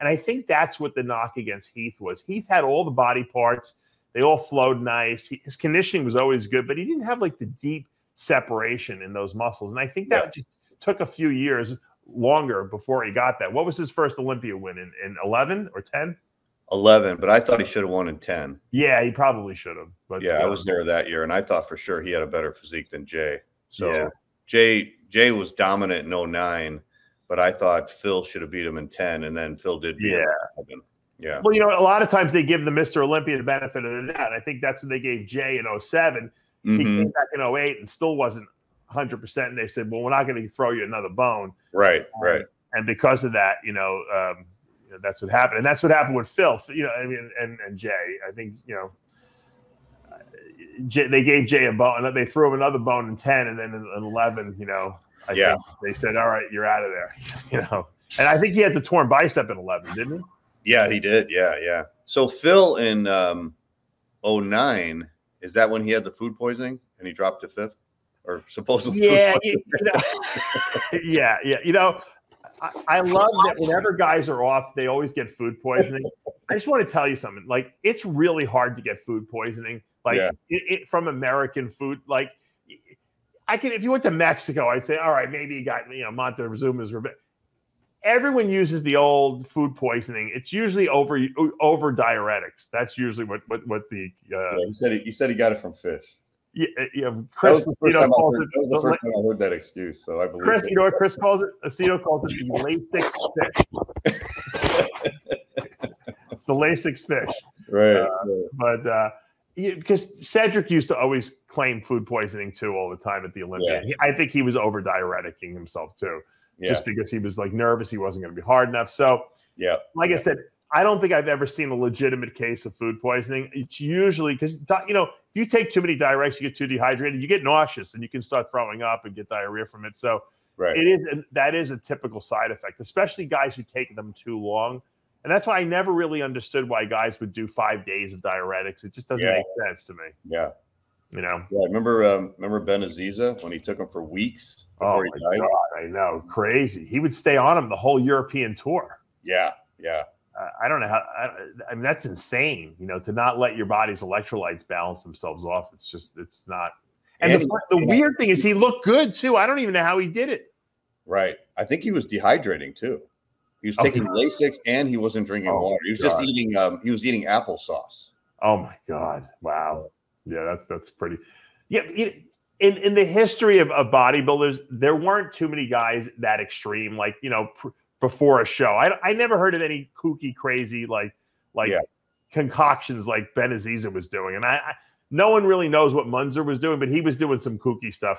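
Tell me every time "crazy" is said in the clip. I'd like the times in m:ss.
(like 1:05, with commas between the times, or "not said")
2:26, 3:00.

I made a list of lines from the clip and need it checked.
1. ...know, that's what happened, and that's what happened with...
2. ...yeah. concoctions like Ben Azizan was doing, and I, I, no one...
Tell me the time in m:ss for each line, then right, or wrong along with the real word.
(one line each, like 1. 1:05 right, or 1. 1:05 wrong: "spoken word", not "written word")
1. 0:44 right
2. 3:01 right.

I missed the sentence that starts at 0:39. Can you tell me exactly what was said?
And they said, well, we're not going to throw you another bone.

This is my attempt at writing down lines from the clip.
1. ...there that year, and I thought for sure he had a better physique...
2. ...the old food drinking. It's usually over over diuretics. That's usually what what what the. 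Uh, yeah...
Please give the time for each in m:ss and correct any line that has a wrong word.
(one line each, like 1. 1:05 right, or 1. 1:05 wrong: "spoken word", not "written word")
1. 0:20 right
2. 1:28 wrong: "poisoning", not "drinking".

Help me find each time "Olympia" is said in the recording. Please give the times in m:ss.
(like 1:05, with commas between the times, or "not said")
0:14, 0:33, 1:53.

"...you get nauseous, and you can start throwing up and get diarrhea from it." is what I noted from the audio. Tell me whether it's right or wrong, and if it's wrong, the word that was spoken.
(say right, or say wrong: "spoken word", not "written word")
right.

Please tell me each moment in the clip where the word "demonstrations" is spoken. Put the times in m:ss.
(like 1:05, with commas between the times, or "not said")
not said.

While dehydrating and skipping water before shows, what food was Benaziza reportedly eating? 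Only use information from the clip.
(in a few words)
Applesauce.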